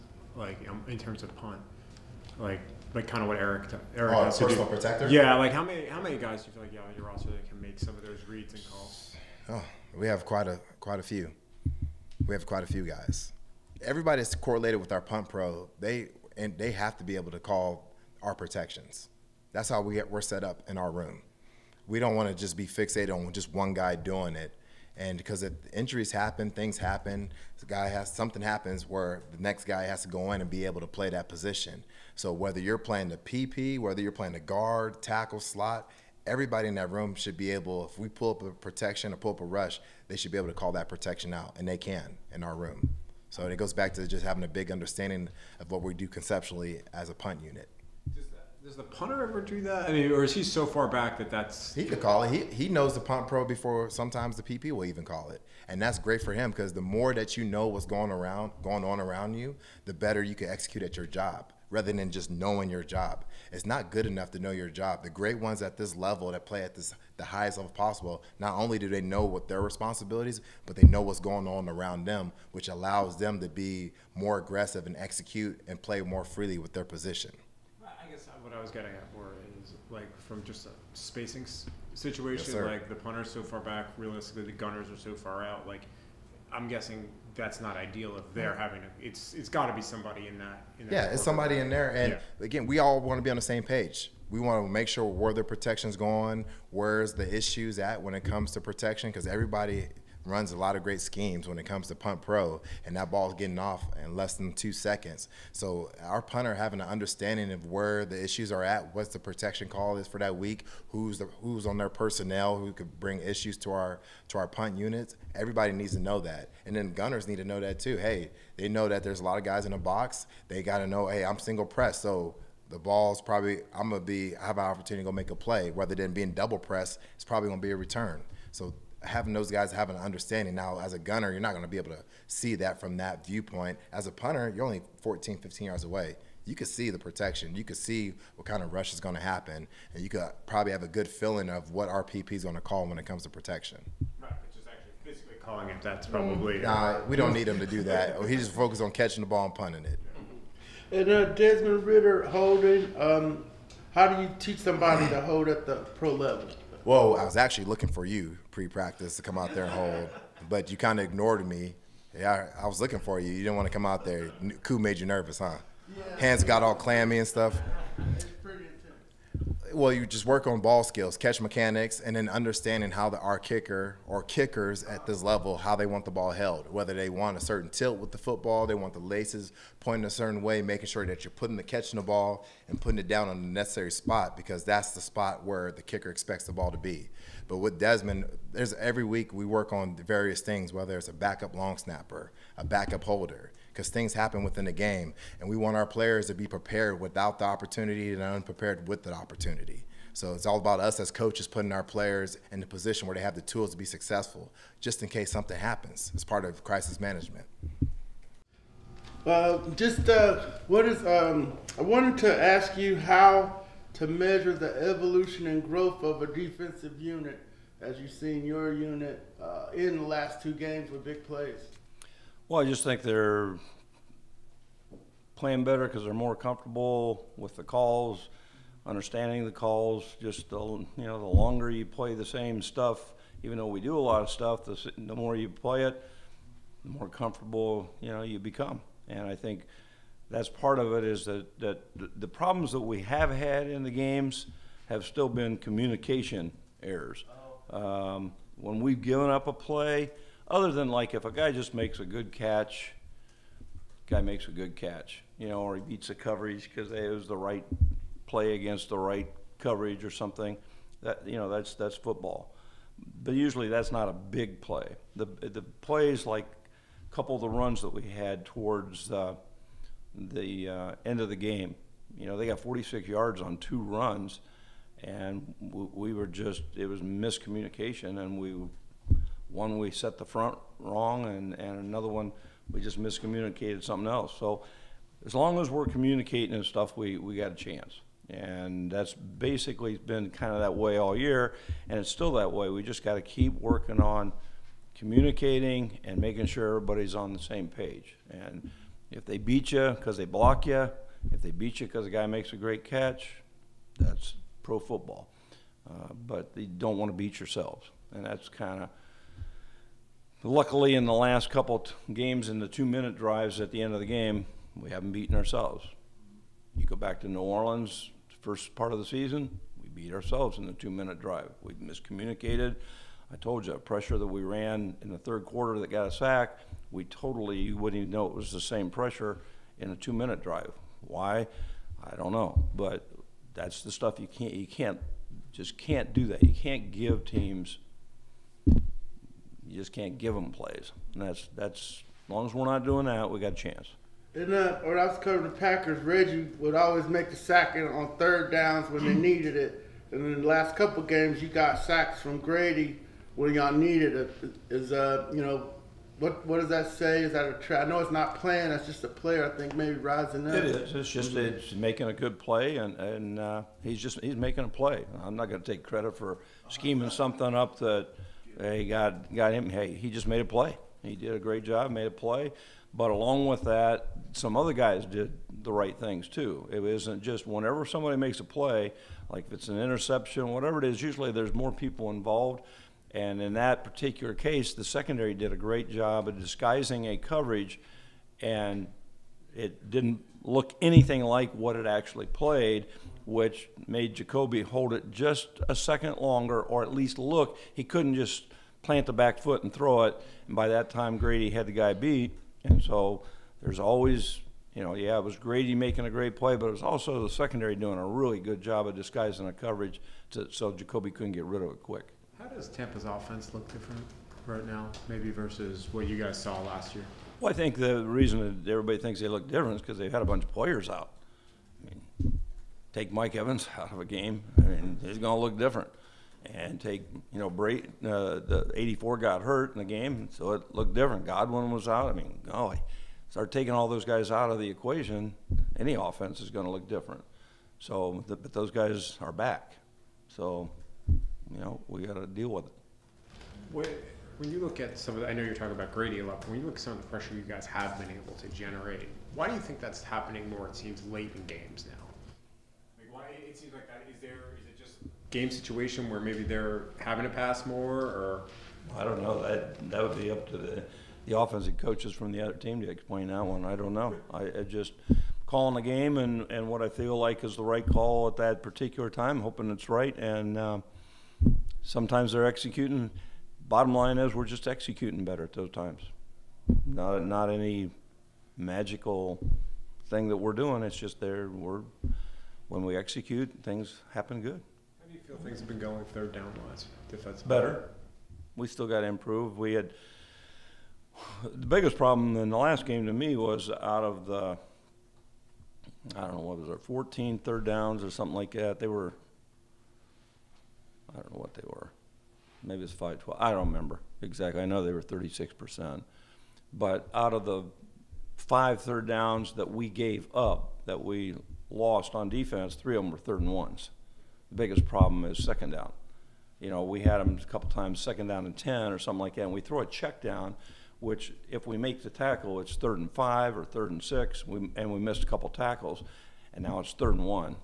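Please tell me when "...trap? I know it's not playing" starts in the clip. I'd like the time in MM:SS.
05:57.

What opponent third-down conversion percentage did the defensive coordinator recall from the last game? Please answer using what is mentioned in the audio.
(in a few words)
36%.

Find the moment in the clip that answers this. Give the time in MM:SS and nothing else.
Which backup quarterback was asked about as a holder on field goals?
02:31.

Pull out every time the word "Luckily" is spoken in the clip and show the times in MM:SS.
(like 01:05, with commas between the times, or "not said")
05:10.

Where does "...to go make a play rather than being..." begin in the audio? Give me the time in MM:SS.
02:05.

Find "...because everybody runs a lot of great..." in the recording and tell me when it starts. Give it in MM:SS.
01:39.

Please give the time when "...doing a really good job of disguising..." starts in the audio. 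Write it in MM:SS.
06:47.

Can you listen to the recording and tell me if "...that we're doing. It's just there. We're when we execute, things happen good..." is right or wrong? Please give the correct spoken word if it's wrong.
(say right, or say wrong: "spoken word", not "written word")
right.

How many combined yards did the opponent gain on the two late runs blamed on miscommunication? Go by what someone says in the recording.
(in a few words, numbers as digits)
46 yards.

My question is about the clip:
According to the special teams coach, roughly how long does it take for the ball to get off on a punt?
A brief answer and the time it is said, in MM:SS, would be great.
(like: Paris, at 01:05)
less than 2 seconds, at 01:44.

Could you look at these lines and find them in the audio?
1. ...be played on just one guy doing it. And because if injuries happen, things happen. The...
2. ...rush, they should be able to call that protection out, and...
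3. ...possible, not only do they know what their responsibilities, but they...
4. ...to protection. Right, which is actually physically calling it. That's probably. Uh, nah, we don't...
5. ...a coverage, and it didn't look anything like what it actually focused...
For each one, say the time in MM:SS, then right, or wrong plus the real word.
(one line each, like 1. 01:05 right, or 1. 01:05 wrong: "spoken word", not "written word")
1. 00:22 wrong: "fixated", not "played"
2. 00:39 right
3. 01:07 right
4. 02:23 right
5. 06:27 wrong: "played", not "focused".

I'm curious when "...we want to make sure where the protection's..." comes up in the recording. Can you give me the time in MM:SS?
01:34.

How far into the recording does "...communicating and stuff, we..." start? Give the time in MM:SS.
04:45.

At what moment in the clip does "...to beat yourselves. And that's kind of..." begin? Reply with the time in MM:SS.
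05:07.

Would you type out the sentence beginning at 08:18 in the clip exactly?
They were I don't know what they were.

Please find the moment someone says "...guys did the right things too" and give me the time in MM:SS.
06:14.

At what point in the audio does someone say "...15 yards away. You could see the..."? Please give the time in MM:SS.
02:15.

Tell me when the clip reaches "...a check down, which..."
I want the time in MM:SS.
08:39.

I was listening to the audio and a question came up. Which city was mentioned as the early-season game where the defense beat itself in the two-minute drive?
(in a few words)
New Orleans.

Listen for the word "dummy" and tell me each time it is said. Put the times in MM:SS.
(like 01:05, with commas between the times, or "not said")
not said.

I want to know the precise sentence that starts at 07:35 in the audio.
game situation where maybe they're having to pass more or?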